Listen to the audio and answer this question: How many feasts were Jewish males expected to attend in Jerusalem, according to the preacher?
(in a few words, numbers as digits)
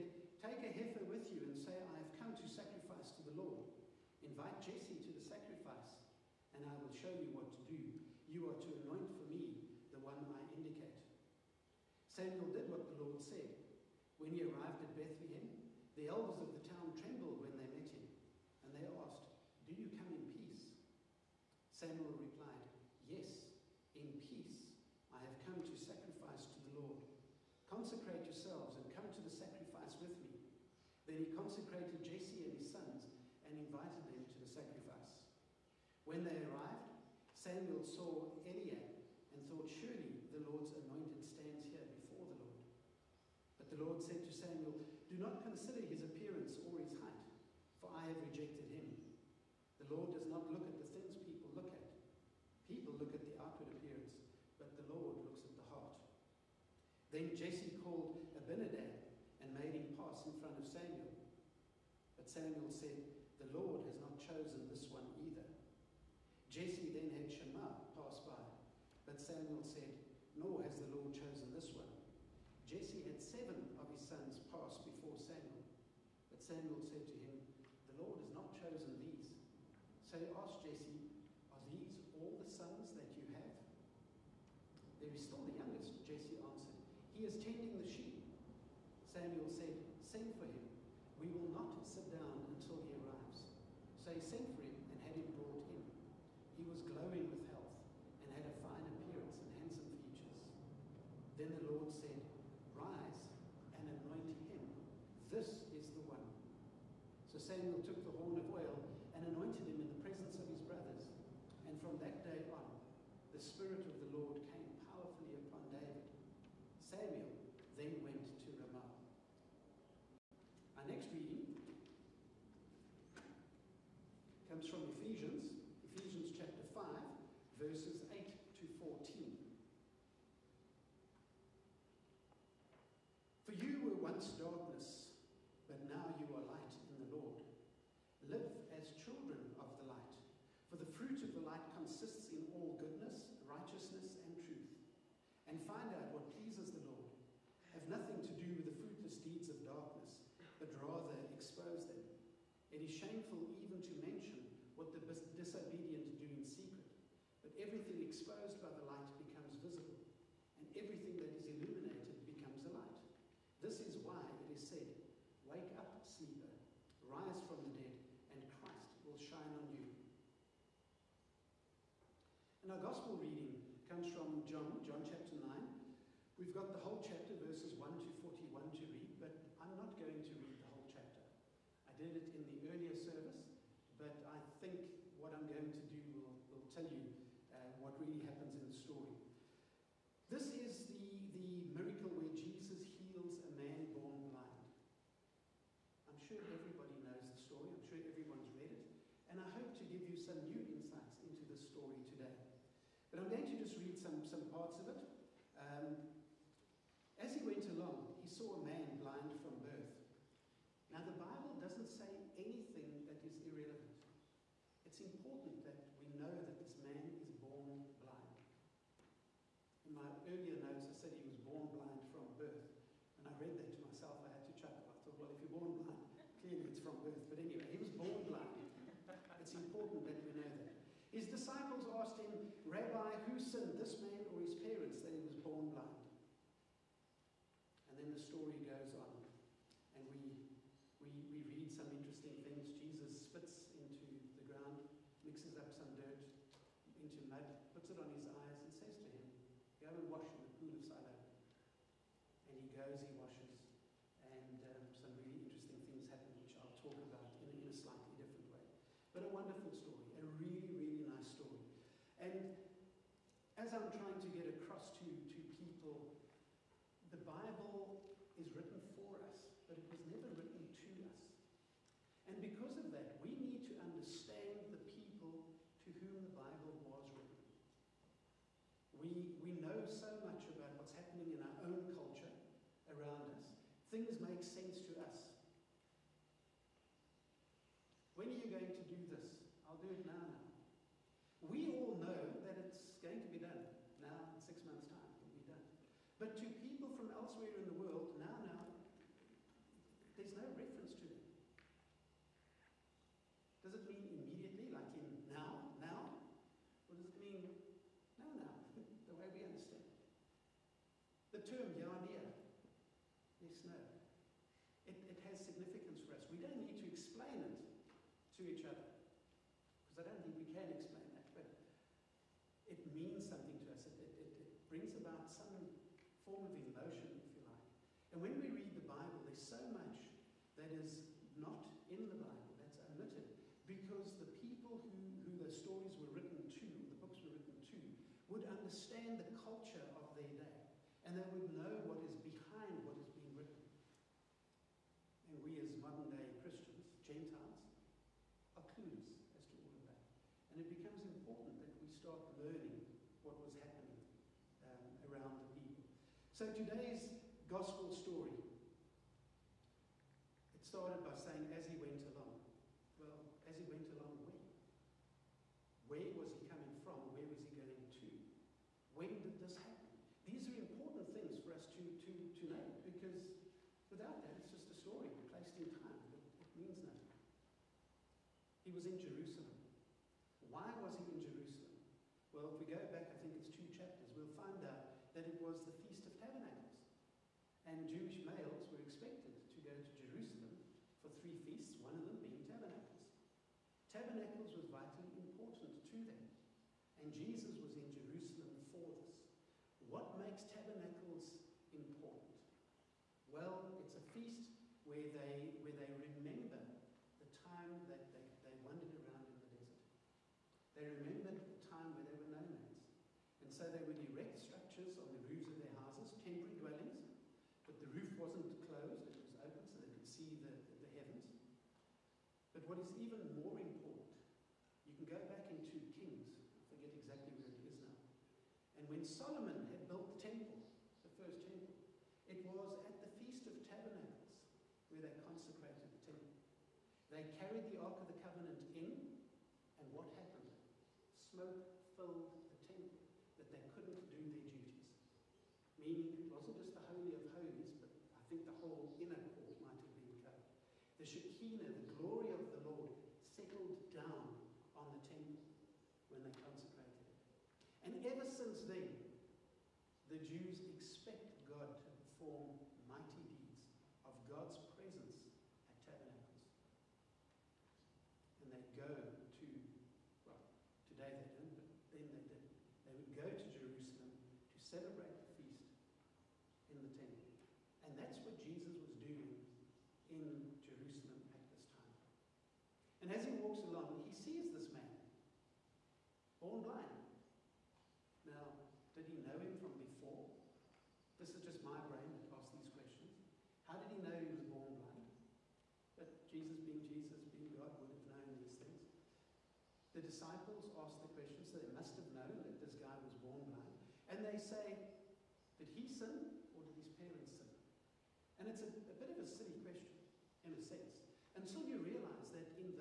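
3.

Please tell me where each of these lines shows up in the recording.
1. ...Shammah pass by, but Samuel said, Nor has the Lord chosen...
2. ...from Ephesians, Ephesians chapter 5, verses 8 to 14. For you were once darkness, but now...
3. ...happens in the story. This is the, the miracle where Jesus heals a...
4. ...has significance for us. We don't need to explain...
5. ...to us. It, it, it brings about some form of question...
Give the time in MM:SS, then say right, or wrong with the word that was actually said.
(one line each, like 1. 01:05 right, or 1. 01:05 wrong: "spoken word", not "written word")
1. 01:07 right
2. 02:04 right
3. 03:08 right
4. 05:15 right
5. 05:23 wrong: "emotion", not "question".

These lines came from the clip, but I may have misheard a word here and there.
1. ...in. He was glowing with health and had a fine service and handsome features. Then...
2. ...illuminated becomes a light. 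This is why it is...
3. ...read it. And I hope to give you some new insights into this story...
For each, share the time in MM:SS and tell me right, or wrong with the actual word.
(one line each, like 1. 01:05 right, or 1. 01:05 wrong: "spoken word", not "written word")
1. 01:35 wrong: "appearance", not "service"
2. 02:41 right
3. 03:18 right.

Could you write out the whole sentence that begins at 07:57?
And that's what Jesus was doing in Jerusalem at this time.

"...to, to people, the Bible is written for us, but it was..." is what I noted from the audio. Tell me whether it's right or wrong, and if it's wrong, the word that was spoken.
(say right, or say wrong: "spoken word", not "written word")
right.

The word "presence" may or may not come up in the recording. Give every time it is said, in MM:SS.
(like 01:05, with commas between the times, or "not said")
01:50, 07:44.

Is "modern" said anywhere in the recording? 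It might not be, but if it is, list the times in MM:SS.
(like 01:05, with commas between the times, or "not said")
05:45.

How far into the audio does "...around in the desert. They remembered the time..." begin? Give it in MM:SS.
06:48.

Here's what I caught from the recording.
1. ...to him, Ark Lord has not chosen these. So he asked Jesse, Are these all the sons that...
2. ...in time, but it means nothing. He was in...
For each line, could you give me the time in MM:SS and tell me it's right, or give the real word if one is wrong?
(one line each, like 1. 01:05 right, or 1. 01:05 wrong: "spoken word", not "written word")
1. 01:17 wrong: "The", not "Ark"
2. 06:15 right.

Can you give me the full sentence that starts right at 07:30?
The Shekinah, the glory of the Lord, settled down on the temple when they consecrated it.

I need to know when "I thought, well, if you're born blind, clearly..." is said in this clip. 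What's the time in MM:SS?
03:44.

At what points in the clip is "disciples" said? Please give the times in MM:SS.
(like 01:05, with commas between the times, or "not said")
03:51, 08:20.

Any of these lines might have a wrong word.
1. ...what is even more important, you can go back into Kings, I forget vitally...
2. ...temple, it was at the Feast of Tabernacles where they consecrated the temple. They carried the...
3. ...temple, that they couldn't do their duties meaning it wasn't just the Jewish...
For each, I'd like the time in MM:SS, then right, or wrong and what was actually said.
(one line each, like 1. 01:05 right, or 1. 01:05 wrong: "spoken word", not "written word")
1. 07:02 wrong: "exactly", not "vitally"
2. 07:11 right
3. 07:22 wrong: "Holy", not "Jewish".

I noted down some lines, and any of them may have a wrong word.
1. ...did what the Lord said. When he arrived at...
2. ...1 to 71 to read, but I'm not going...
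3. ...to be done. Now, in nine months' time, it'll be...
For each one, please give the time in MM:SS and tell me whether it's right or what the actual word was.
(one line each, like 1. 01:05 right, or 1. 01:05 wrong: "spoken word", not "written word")
1. 00:12 right
2. 02:57 wrong: "41", not "71"
3. 04:53 wrong: "six", not "nine".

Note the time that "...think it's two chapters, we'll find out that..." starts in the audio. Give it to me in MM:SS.
06:23.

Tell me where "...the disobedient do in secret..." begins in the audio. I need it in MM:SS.
02:34.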